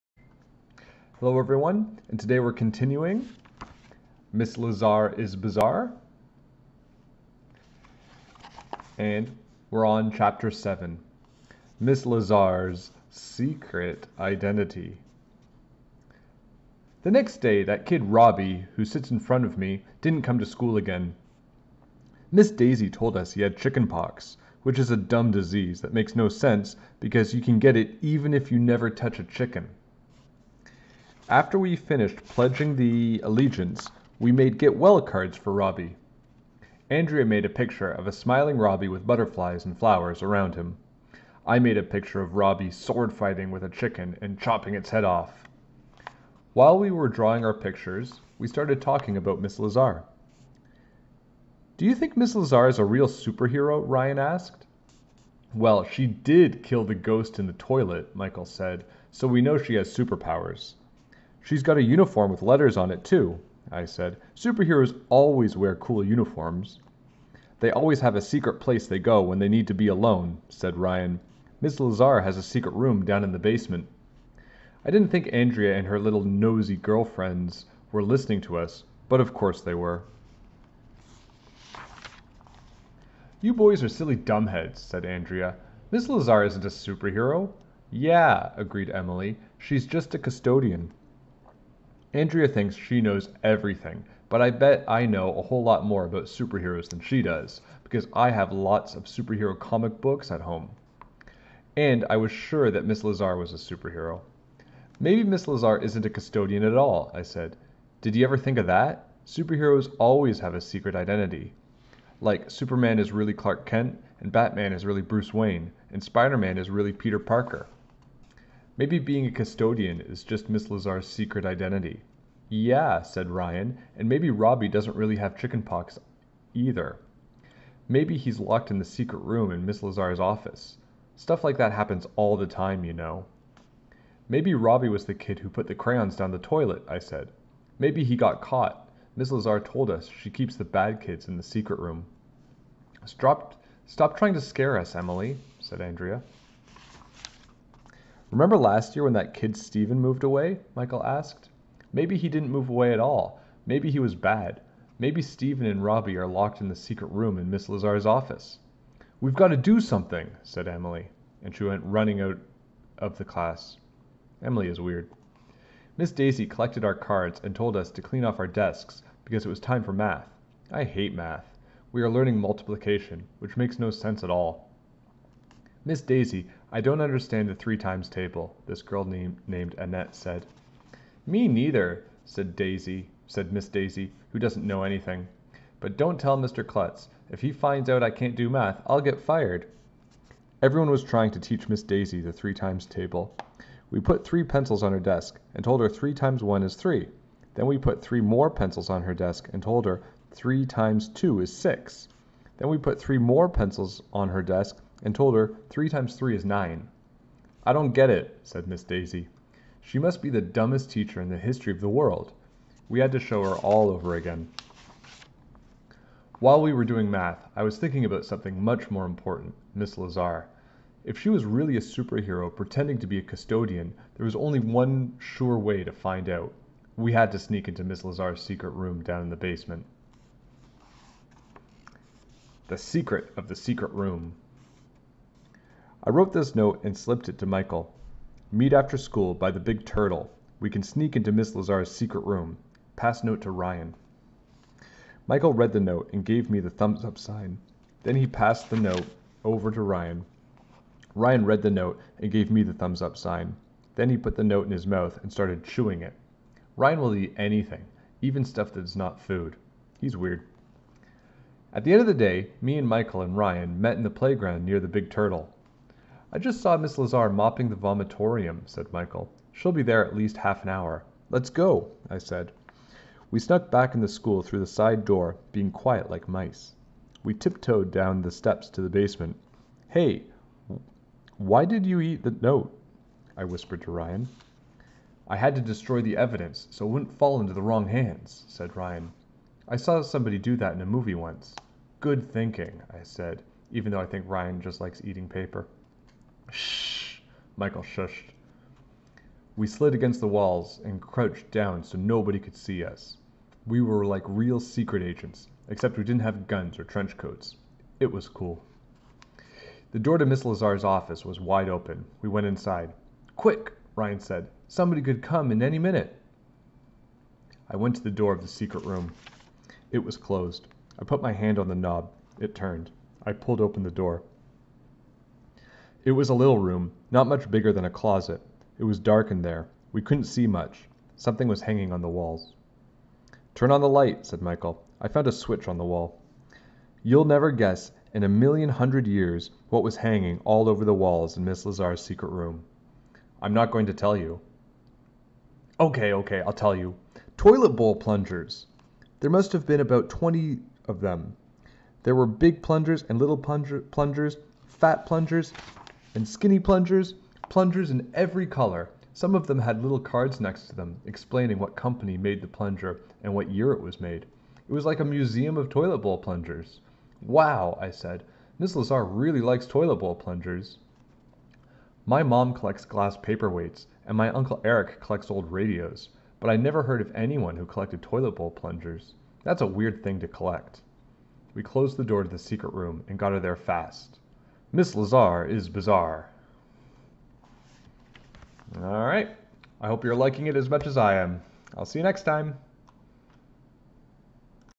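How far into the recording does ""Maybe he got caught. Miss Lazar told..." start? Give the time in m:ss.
2:17.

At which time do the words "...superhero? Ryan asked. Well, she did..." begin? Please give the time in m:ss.
0:53.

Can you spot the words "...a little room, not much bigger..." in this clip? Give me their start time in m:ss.
5:26.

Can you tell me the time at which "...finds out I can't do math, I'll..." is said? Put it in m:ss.
3:07.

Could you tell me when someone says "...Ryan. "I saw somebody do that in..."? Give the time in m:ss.
4:48.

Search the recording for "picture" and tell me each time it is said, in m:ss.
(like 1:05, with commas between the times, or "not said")
0:37, 0:41, 0:47.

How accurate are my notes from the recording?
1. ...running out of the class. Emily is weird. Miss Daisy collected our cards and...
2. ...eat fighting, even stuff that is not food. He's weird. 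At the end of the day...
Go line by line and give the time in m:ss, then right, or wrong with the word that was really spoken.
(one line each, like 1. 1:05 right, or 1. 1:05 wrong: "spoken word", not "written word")
1. 2:41 right
2. 4:17 wrong: "anything", not "fighting".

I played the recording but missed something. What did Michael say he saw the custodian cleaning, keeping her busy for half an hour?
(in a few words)
The vomitorium.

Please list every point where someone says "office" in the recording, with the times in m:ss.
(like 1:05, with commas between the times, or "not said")
2:10, 2:38, 5:10.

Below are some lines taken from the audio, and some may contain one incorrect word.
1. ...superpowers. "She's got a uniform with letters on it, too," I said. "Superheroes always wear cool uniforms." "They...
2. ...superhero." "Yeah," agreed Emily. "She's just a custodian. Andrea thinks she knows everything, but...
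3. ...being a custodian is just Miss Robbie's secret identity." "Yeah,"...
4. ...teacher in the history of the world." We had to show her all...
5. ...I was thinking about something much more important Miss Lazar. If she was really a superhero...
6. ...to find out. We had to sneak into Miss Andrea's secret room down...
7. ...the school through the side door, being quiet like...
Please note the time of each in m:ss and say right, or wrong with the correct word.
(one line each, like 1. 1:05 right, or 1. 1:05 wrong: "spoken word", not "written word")
1. 0:59 right
2. 1:26 right
3. 1:58 wrong: "Lazar", not "Robbie"
4. 3:30 right
5. 3:37 right
6. 3:45 wrong: "Lazar", not "Andrea"
7. 4:33 right.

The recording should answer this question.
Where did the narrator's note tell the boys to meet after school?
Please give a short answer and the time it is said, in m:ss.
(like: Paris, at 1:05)
By the big turtle, at 3:59.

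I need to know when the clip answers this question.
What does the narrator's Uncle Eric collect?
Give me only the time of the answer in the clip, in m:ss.
6:15.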